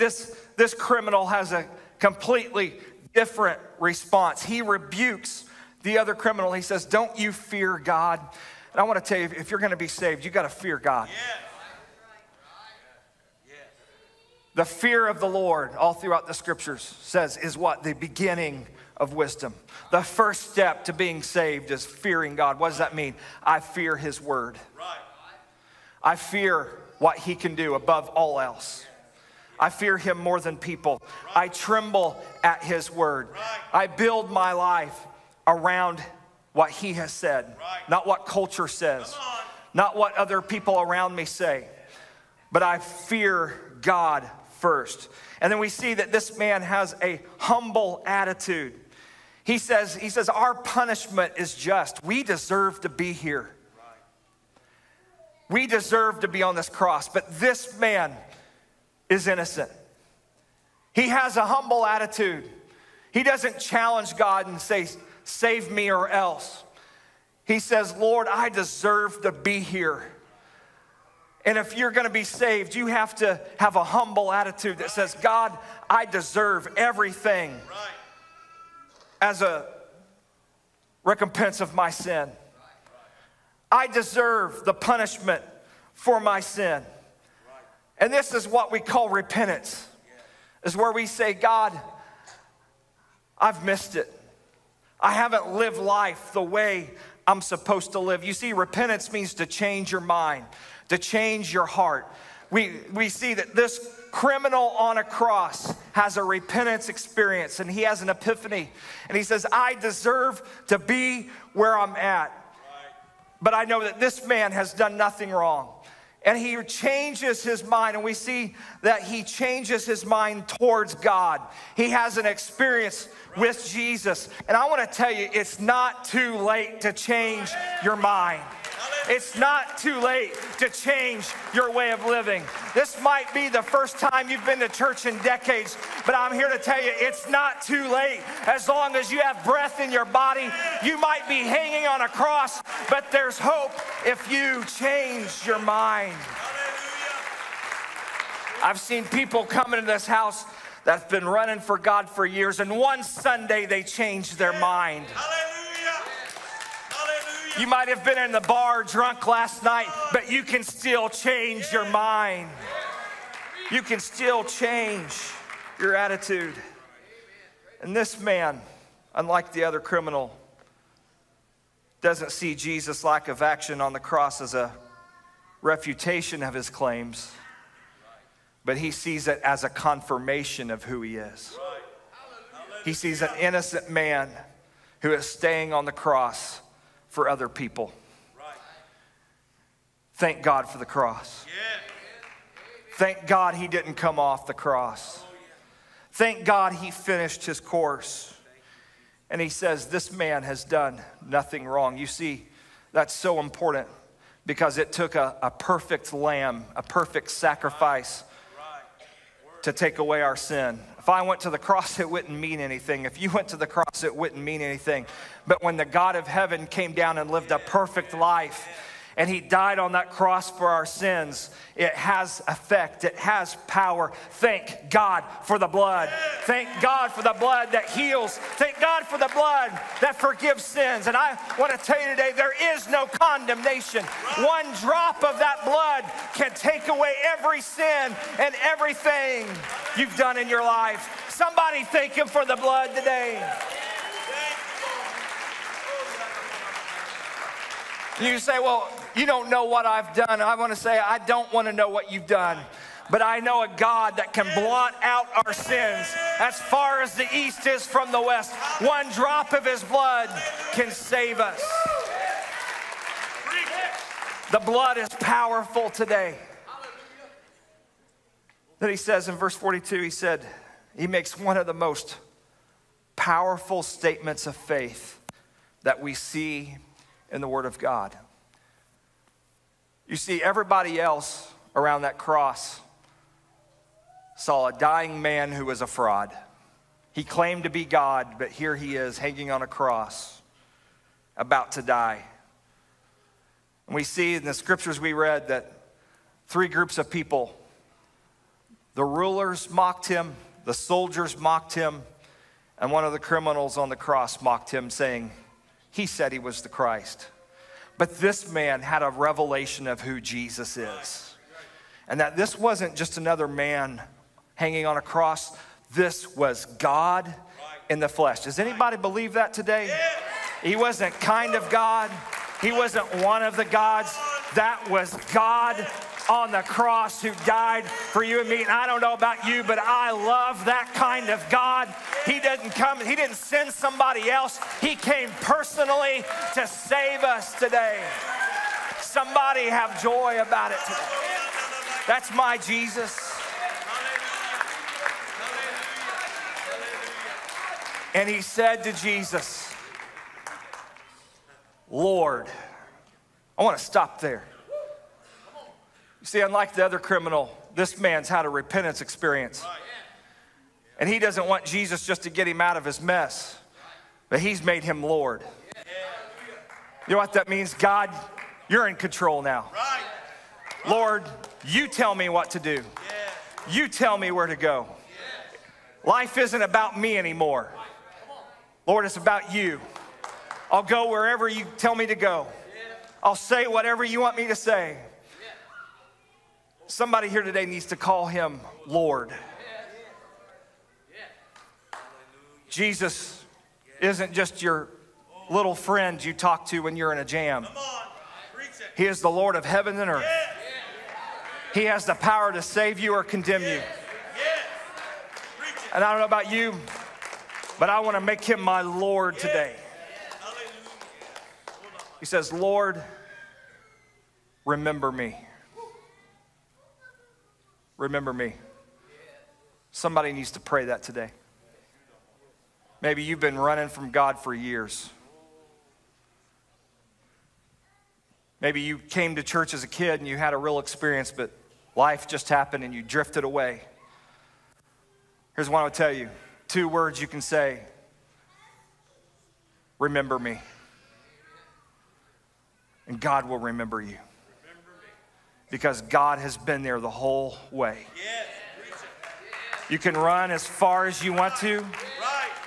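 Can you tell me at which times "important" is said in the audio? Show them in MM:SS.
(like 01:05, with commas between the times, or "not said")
03:23.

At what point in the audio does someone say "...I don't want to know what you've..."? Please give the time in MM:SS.
04:10.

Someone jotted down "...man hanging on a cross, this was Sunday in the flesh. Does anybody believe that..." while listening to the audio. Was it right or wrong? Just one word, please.
wrong.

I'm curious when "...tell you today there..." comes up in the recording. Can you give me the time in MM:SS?
03:51.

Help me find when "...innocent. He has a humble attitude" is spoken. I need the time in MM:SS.
00:59.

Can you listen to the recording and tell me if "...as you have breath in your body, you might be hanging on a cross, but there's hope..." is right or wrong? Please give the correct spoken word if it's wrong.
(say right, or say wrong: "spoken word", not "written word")
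right.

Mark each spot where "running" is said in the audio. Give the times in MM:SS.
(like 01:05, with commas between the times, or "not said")
02:31, 07:03.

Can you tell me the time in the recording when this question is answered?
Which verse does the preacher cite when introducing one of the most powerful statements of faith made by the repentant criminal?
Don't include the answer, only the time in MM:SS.
04:29.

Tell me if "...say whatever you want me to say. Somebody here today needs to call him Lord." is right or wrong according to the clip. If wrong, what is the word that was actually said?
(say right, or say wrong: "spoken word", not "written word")
right.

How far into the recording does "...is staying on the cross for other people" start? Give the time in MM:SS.
03:05.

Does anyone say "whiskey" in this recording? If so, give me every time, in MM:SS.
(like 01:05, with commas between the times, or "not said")
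not said.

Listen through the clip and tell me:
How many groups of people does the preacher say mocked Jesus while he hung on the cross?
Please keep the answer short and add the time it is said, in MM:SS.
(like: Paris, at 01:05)
3, at 04:56.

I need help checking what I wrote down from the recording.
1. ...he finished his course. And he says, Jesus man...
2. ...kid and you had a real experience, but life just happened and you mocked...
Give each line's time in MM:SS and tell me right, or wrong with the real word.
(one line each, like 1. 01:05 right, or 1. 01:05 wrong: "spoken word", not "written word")
1. 03:16 wrong: "This", not "Jesus"
2. 07:09 wrong: "drifted", not "mocked".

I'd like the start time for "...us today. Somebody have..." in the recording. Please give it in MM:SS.
05:37.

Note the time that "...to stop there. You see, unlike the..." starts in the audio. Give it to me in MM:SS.
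05:53.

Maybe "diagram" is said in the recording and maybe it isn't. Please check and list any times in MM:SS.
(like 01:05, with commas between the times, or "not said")
not said.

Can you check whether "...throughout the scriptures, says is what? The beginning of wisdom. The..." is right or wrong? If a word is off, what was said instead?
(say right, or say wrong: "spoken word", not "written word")
right.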